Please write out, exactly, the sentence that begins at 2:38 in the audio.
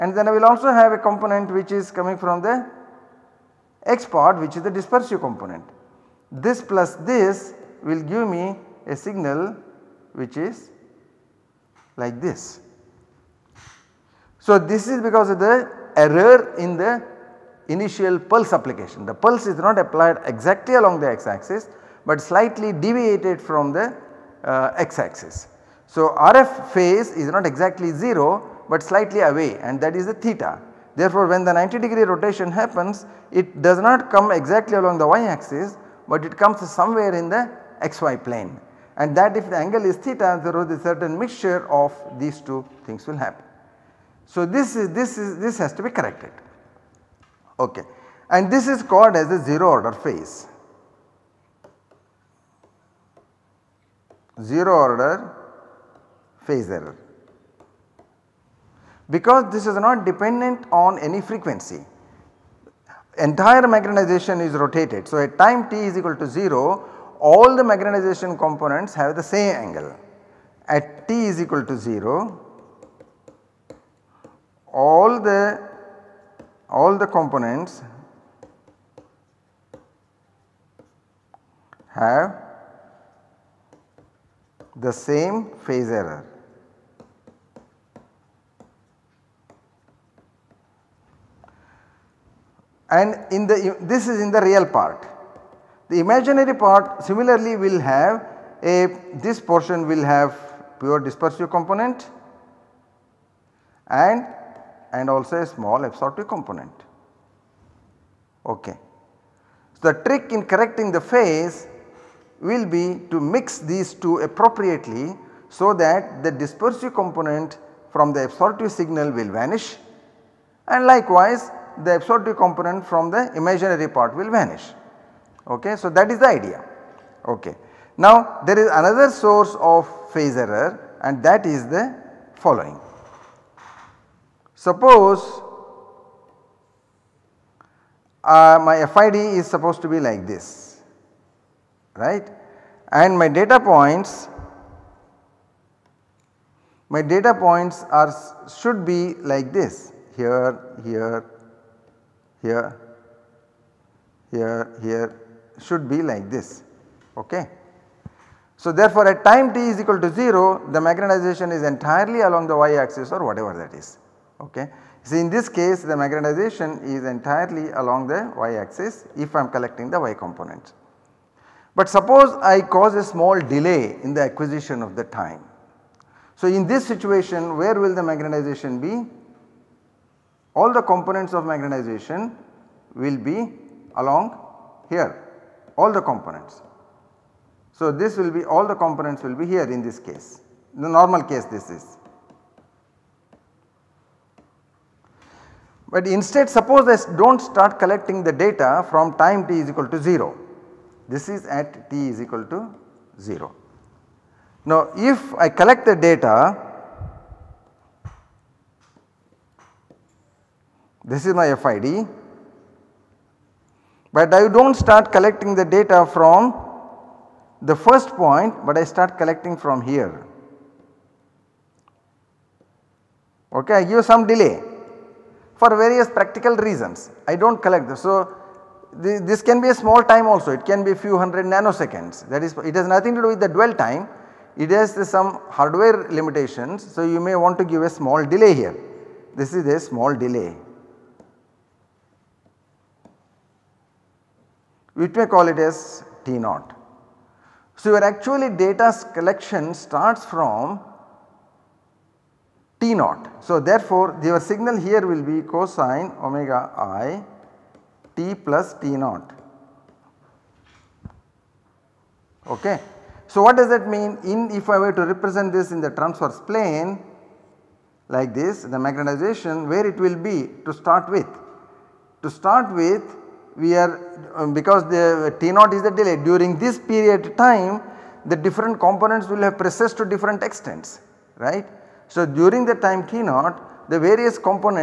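So therefore at time t is equal to 0 the magnetization is entirely along the y axis or whatever that is.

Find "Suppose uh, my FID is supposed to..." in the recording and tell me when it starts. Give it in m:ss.
2:14.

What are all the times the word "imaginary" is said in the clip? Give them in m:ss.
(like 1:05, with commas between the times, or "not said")
1:35, 2:03.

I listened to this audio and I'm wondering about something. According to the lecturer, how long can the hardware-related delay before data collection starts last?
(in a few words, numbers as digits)
few hundred nanoseconds.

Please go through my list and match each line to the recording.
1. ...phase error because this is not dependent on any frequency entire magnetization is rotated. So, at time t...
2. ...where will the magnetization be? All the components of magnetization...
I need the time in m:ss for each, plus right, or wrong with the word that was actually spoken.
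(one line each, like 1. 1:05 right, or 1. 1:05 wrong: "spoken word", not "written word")
1. 0:56 right
2. 2:57 right.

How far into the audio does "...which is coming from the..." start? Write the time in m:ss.
0:01.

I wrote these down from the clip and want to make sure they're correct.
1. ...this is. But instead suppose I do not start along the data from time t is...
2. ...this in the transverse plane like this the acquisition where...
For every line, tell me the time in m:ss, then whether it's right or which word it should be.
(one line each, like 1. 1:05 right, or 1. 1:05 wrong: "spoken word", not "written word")
1. 3:11 wrong: "collecting", not "along"
2. 4:25 wrong: "magnetization", not "acquisition".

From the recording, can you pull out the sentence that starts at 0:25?
So, RF phase is not exactly 0 but slightly away and that is the theta.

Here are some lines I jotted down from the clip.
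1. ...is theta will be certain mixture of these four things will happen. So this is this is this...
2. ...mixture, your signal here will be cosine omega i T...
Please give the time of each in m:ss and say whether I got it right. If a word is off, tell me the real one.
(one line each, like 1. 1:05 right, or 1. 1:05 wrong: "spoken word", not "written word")
1. 0:39 wrong: "two", not "four"
2. 4:13 wrong: "therefore", not "mixture".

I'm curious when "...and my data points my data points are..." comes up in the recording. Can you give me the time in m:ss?
2:22.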